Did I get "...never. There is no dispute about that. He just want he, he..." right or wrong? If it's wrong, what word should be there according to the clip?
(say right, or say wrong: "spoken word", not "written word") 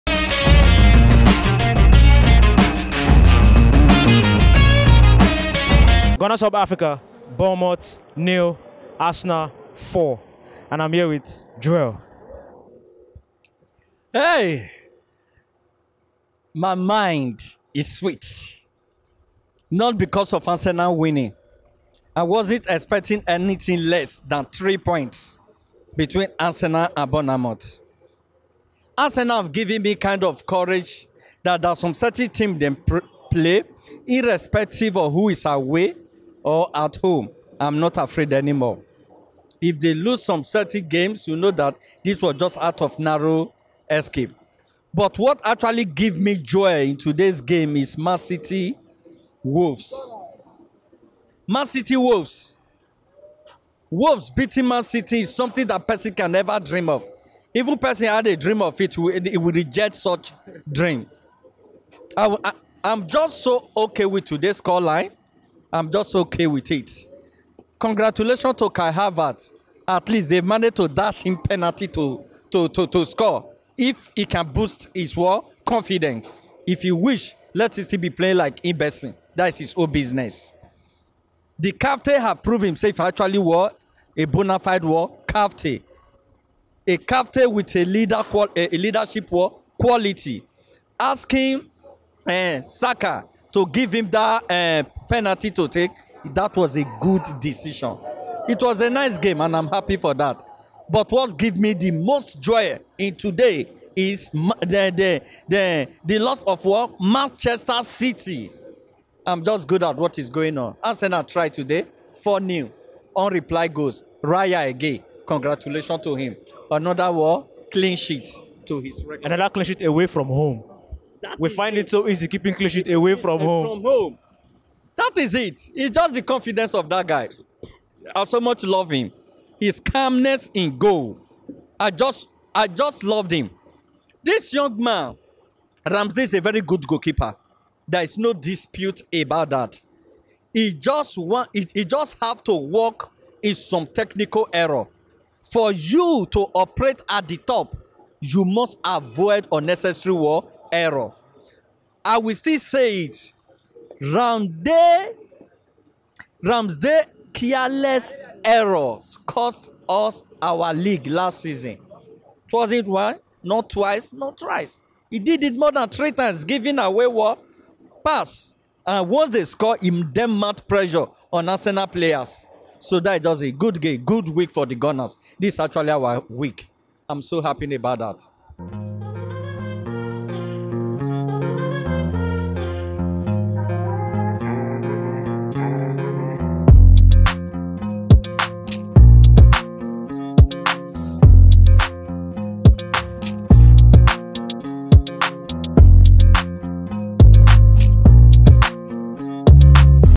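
wrong: "goalkeeper", not "never".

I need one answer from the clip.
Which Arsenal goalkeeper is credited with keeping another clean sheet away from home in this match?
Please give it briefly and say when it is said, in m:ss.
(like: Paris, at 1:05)
Raya, at 1:54.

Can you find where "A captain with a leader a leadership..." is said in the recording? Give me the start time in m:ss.
1:26.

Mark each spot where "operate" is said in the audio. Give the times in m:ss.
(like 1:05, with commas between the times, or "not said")
2:26.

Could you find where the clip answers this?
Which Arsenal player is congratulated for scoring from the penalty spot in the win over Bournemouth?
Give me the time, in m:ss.
1:08.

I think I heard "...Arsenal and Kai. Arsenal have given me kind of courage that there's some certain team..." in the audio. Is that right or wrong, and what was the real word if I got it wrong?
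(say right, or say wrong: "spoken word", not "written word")
wrong: "Bournemouth", not "Kai".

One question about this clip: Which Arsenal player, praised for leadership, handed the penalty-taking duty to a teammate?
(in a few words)
Saka.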